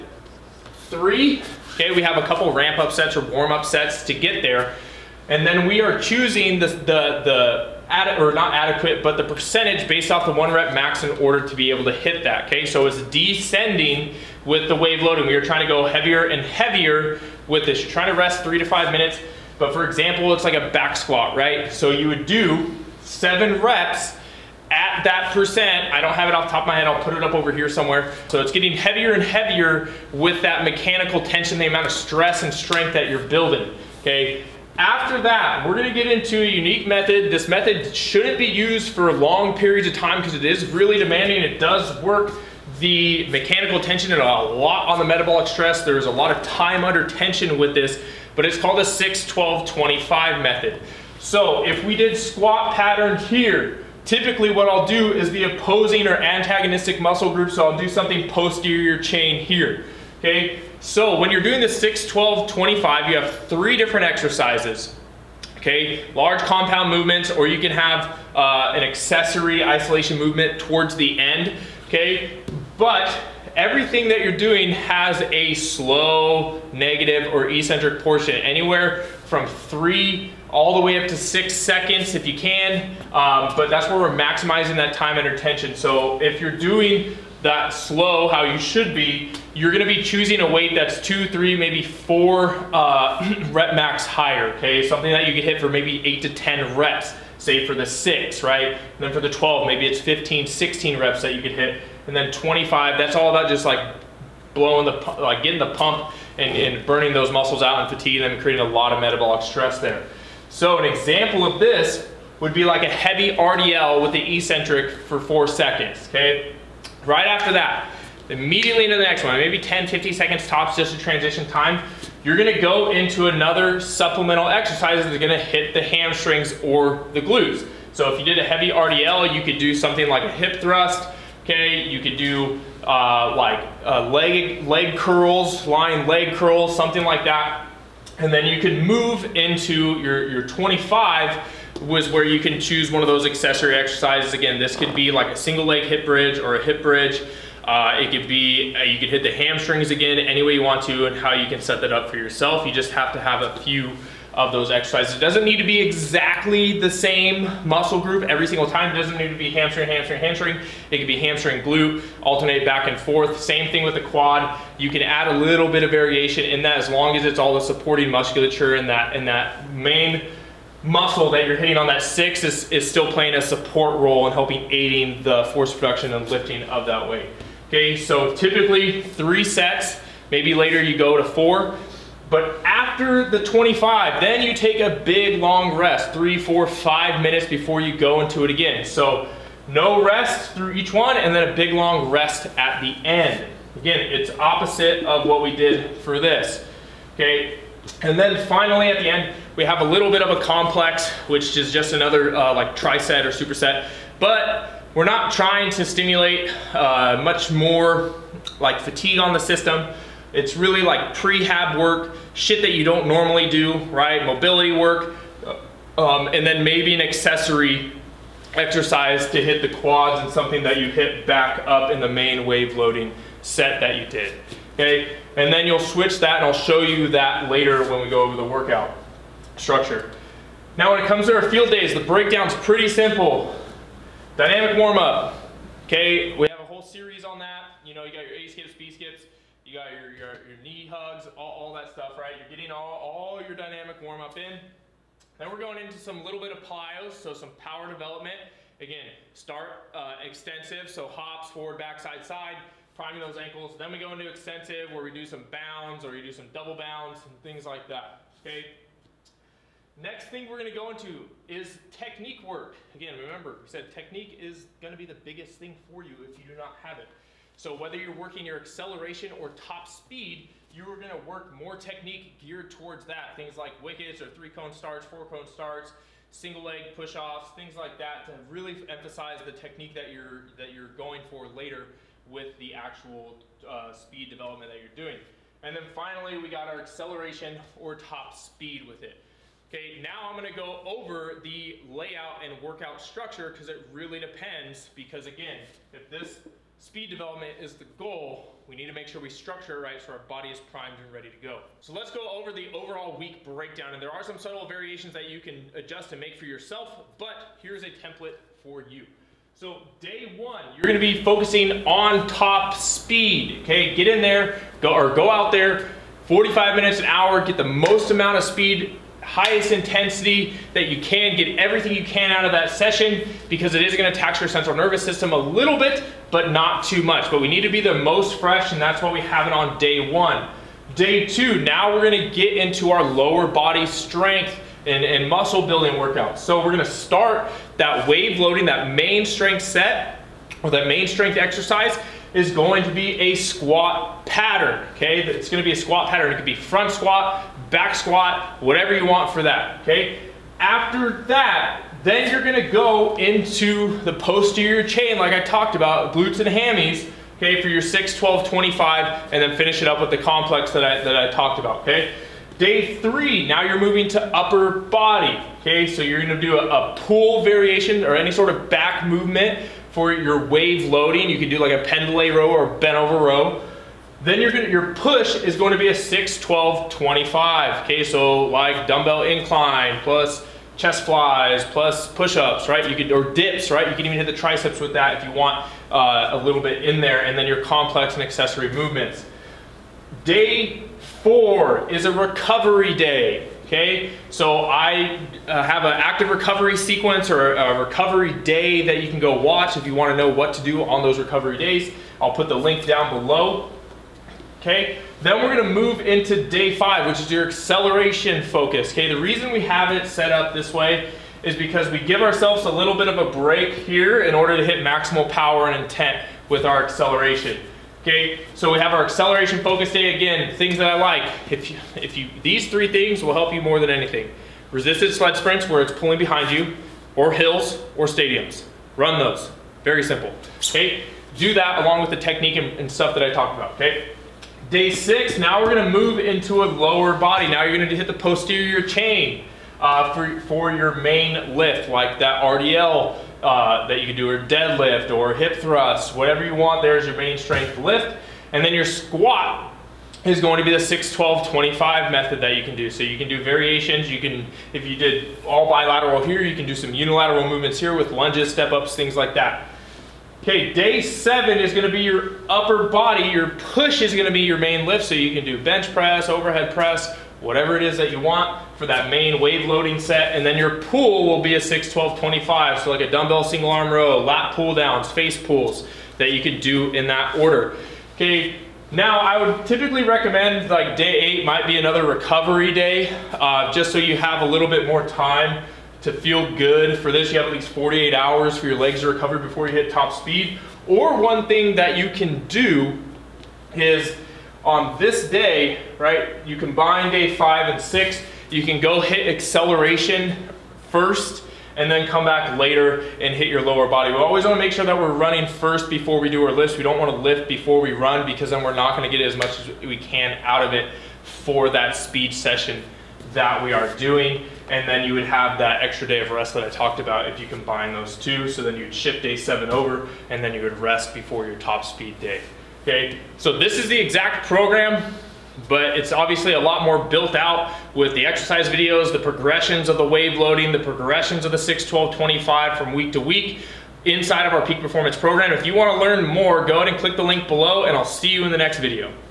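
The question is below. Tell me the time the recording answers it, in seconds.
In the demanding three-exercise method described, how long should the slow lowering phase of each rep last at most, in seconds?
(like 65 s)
81 s.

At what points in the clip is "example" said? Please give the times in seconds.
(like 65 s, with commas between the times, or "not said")
19 s, 110 s.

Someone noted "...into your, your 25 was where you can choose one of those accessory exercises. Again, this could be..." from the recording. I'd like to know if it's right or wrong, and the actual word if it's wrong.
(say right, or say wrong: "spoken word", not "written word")
right.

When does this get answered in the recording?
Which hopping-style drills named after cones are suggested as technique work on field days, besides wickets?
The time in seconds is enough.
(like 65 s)
274 s.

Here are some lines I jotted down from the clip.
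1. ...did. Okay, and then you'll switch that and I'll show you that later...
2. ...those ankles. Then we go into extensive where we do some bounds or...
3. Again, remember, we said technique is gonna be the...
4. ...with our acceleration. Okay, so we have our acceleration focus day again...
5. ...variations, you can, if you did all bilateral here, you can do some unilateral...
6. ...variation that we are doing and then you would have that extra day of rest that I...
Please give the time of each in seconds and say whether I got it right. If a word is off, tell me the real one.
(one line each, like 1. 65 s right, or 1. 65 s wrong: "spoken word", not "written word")
1. 224 s right
2. 253 s right
3. 262 s right
4. 416 s right
5. 453 s right
6. 512 s wrong: "session", not "variation".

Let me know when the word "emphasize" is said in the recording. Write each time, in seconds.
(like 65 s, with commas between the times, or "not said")
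278 s.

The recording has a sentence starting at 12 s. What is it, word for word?
So it's descending with the wave loading.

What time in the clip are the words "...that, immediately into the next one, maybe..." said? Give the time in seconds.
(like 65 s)
117 s.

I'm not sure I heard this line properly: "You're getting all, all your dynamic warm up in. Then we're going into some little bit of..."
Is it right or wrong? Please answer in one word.
right.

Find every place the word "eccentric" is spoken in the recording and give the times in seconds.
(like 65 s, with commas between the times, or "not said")
77 s, 114 s.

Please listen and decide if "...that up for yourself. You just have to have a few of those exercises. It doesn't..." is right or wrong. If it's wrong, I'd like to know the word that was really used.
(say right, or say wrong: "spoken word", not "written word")
right.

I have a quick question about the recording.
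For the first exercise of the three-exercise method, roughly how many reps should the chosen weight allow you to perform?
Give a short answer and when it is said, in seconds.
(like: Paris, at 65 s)
8 to 10, at 96 s.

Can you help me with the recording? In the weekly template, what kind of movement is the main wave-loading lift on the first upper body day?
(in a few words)
pull variation.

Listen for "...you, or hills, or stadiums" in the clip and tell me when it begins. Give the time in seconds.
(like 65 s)
426 s.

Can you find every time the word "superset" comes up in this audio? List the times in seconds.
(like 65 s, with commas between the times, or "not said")
203 s.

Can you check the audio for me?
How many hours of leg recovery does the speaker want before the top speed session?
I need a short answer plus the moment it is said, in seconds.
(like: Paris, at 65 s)
48 hours, at 487 s.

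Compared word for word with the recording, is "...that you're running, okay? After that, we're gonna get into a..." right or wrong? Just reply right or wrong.
wrong.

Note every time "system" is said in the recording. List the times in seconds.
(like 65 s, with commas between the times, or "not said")
209 s, 325 s.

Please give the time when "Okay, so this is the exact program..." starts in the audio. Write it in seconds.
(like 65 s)
522 s.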